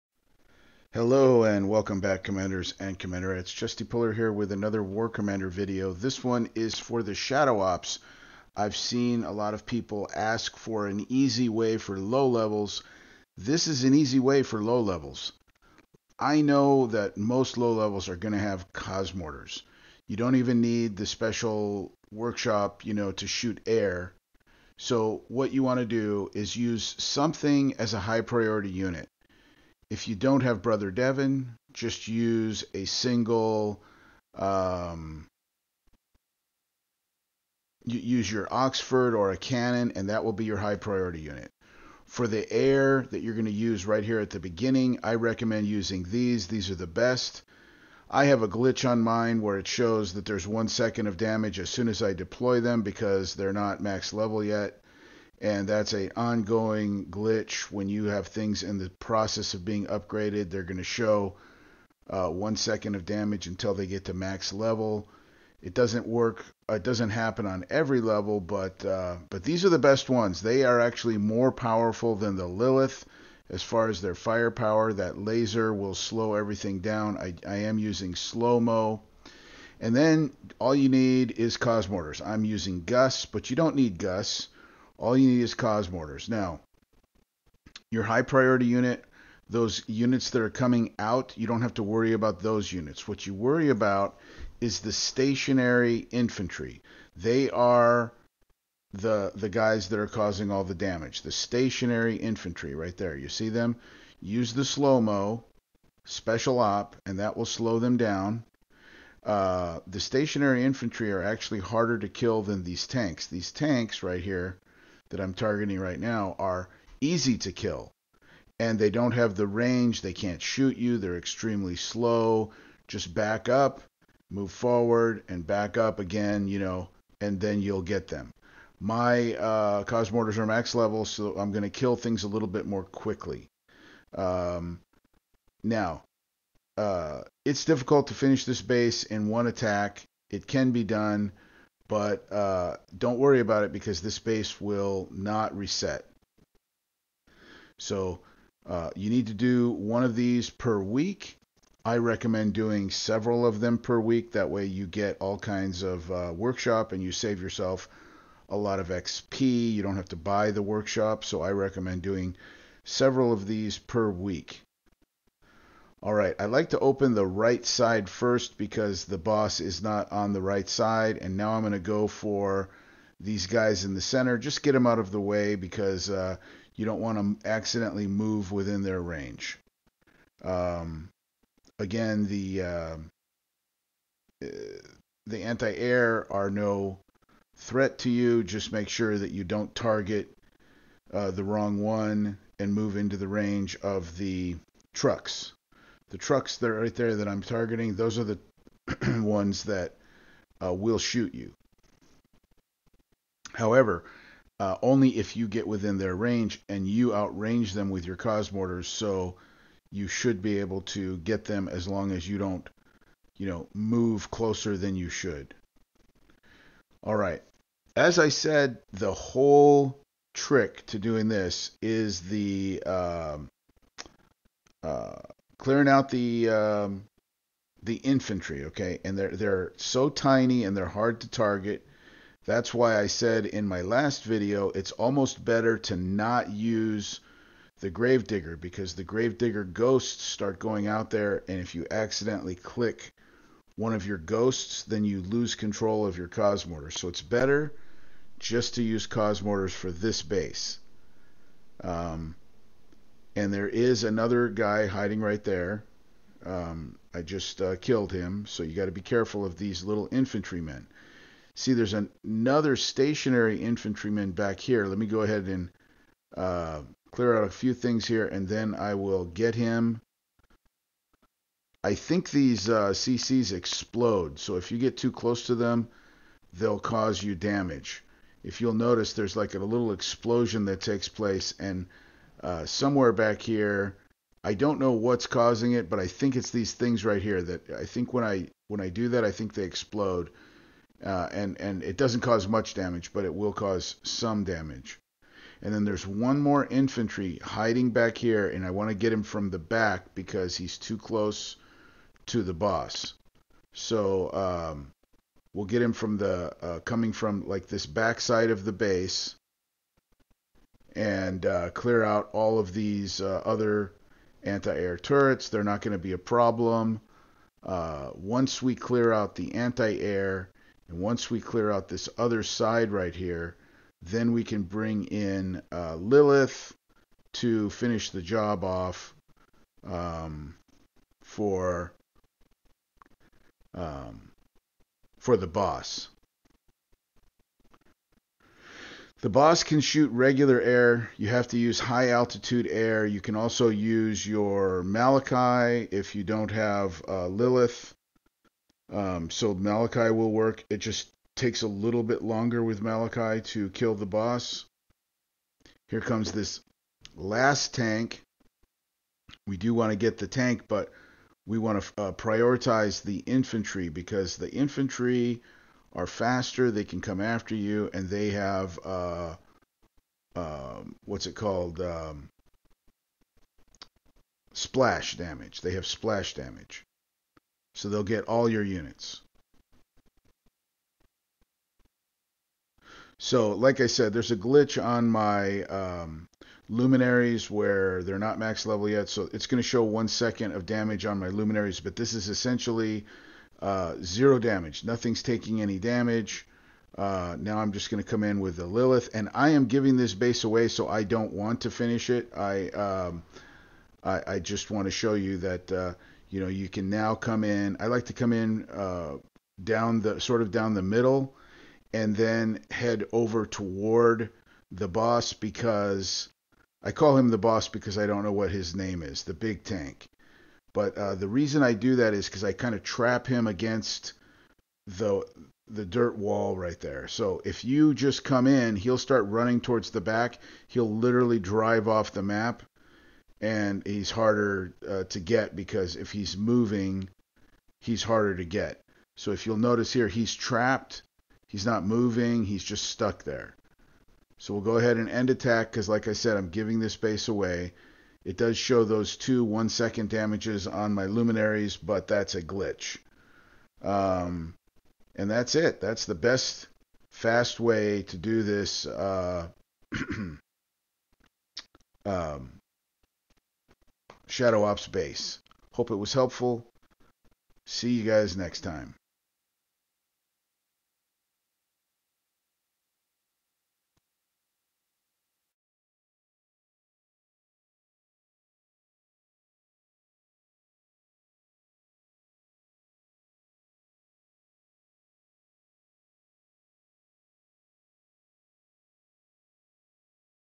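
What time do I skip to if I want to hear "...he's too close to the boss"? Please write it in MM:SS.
05:00.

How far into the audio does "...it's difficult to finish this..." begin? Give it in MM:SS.
02:17.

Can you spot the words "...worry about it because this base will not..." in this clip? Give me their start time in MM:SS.
02:23.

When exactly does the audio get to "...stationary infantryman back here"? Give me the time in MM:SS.
04:22.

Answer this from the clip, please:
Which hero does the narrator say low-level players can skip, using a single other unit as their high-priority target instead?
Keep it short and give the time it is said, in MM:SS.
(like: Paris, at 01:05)
Brother Devin, at 00:30.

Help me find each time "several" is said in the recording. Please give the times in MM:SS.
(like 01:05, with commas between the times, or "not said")
02:32, 02:42.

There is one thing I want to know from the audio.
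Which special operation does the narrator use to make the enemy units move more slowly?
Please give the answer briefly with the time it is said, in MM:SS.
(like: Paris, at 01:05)
Slow mo, at 01:18.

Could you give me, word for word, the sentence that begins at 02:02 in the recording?
Just back up, move forward, and back up again, you know, and then you'll get them.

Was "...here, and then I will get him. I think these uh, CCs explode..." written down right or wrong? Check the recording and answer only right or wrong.
right.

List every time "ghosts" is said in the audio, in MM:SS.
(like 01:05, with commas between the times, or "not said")
03:59, 04:04.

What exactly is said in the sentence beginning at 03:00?
Um, again, the uh, uh, the anti-air are no threat to you.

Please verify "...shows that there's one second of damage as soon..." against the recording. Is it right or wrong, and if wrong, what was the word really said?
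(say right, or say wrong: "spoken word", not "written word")
right.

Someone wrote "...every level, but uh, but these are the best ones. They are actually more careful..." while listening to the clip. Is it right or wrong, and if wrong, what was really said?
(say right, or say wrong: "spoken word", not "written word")
wrong: "powerful", not "careful".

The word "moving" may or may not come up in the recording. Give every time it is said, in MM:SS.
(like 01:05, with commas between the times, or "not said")
07:16, 07:21.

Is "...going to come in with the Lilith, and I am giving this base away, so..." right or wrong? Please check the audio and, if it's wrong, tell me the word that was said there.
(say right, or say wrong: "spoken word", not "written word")
right.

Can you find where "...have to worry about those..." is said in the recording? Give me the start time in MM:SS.
01:31.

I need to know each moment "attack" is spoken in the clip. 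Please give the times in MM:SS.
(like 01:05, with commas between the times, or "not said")
02:19, 07:25.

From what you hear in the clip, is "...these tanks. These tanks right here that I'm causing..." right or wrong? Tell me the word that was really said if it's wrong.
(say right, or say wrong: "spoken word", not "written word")
wrong: "targeting", not "causing".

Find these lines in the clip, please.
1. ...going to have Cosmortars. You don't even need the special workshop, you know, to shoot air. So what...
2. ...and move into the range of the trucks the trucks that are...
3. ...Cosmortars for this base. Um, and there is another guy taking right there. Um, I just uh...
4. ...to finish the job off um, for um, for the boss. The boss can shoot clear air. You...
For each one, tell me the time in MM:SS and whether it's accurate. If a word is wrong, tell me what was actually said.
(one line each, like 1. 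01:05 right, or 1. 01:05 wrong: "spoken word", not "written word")
1. 00:18 right
2. 03:12 right
3. 04:09 wrong: "hiding", not "taking"
4. 05:27 wrong: "regular", not "clear".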